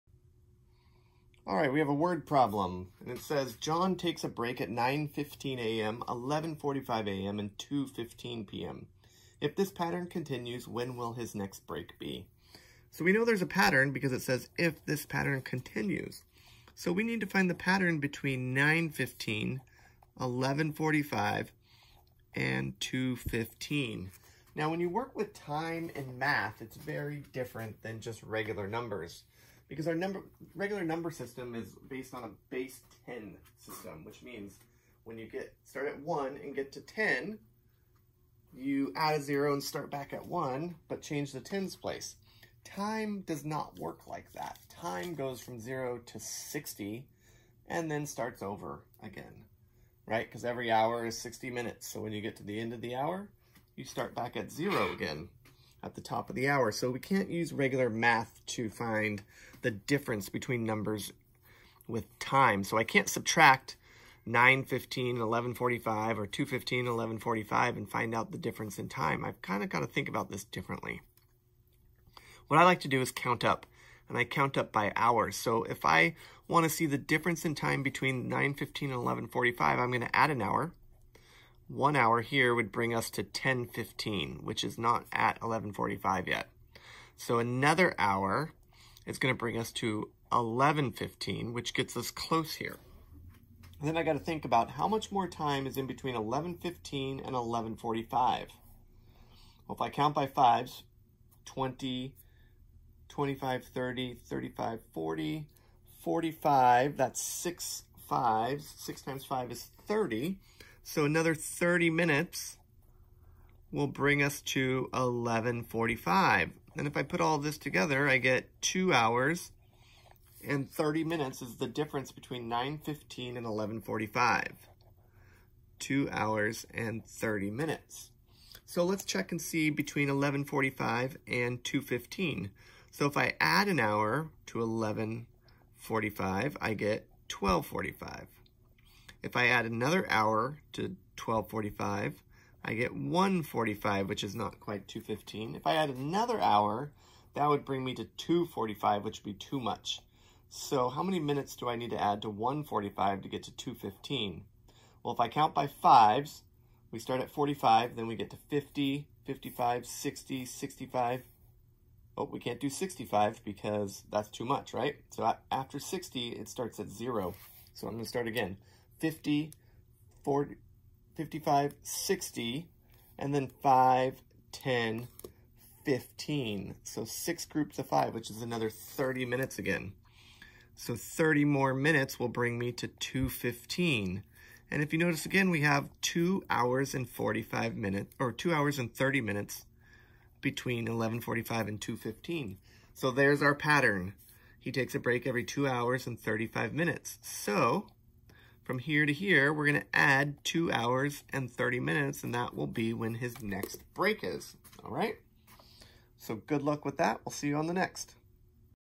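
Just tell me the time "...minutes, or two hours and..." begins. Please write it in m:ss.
3:07.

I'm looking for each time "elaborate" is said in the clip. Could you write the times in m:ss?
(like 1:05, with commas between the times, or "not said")
not said.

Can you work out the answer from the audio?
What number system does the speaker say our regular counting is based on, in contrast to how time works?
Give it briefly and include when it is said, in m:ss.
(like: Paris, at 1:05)
base 10, at 0:32.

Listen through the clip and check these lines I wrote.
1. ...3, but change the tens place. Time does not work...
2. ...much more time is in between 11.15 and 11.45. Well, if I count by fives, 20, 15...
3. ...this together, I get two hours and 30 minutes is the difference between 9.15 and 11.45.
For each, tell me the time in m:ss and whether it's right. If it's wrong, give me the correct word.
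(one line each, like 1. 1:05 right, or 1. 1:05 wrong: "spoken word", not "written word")
1. 0:40 wrong: "1", not "3"
2. 1:34 wrong: "25", not "15"
3. 1:57 right.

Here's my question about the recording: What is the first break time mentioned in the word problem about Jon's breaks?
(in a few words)
9:15 a.m.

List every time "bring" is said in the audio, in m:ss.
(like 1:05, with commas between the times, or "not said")
1:22, 1:29, 1:53, 2:27, 3:02.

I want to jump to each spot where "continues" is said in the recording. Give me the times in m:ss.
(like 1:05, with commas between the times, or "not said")
0:10, 0:15.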